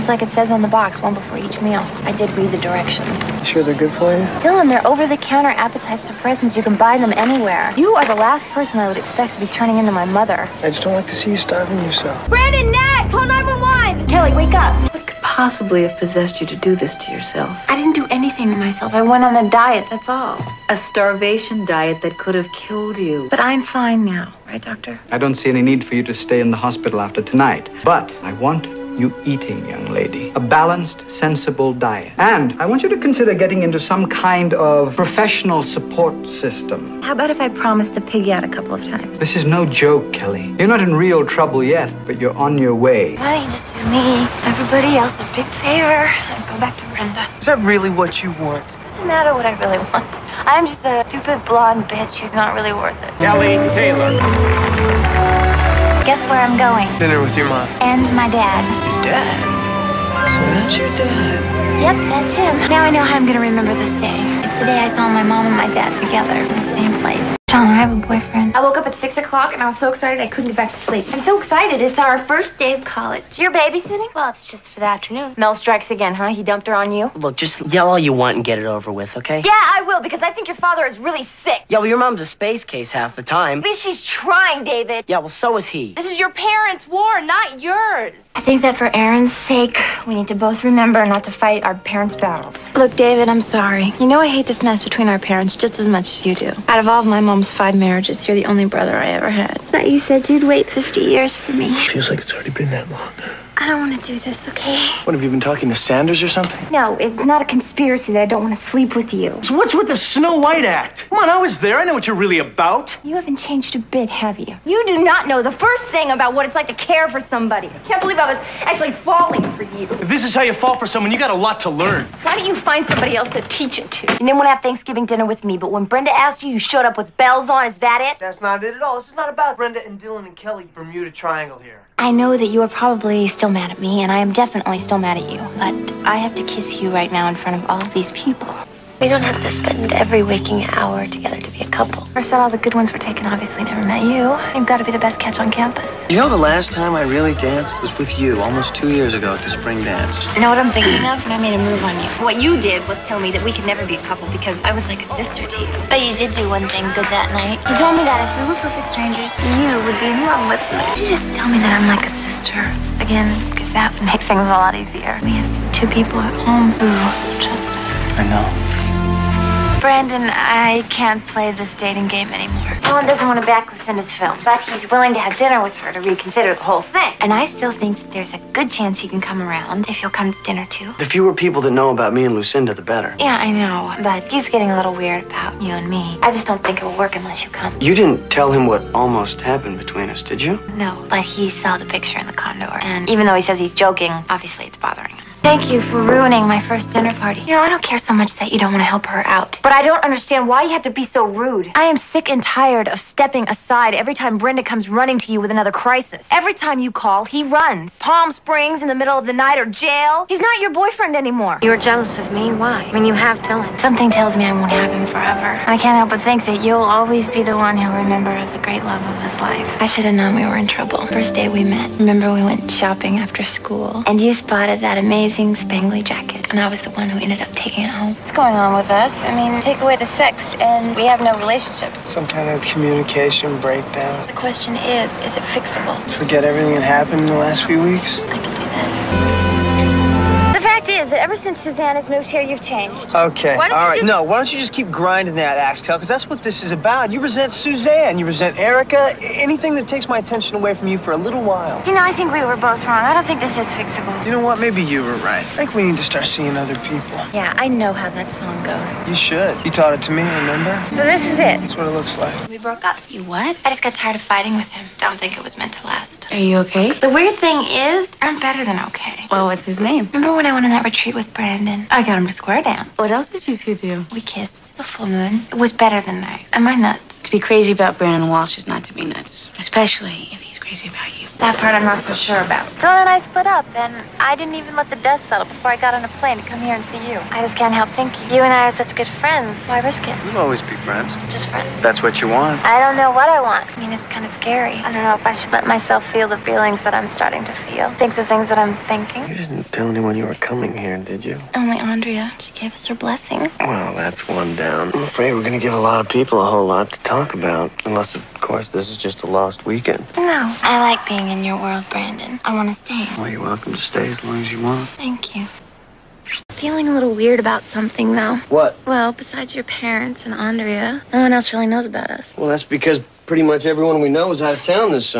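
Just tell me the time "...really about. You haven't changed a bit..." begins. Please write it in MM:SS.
01:52.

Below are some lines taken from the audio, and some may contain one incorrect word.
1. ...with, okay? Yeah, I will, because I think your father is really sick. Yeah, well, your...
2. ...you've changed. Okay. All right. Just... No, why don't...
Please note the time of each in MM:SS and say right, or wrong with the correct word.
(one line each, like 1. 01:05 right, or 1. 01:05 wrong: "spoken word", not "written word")
1. 01:18 right
2. 04:02 right.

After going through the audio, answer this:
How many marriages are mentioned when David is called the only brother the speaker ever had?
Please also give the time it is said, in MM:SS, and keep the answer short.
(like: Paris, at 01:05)
5, at 01:37.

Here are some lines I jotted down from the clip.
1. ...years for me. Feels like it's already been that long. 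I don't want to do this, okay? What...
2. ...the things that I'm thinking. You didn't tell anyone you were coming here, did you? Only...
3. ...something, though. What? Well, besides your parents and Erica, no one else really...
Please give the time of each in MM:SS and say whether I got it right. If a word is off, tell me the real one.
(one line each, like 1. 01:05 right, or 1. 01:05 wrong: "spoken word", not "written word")
1. 01:40 right
2. 04:58 right
3. 05:17 wrong: "Andrea", not "Erica".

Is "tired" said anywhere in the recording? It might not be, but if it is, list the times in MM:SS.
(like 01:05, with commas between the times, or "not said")
03:22, 04:23.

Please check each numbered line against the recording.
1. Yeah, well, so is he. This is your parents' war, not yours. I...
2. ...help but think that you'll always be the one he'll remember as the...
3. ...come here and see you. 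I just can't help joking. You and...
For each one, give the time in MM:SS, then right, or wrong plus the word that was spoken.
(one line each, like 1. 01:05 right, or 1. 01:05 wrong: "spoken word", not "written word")
1. 01:25 right
2. 03:35 right
3. 04:46 wrong: "thinking", not "joking".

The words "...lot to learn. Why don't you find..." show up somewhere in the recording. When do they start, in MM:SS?
02:01.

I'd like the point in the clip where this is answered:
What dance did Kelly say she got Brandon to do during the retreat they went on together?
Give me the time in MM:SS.
04:32.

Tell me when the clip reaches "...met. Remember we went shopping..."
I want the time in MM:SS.
03:41.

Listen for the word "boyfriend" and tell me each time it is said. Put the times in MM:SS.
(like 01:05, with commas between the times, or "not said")
01:08, 03:30.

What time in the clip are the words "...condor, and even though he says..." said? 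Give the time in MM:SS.
03:12.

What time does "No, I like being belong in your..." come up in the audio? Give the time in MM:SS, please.
05:10.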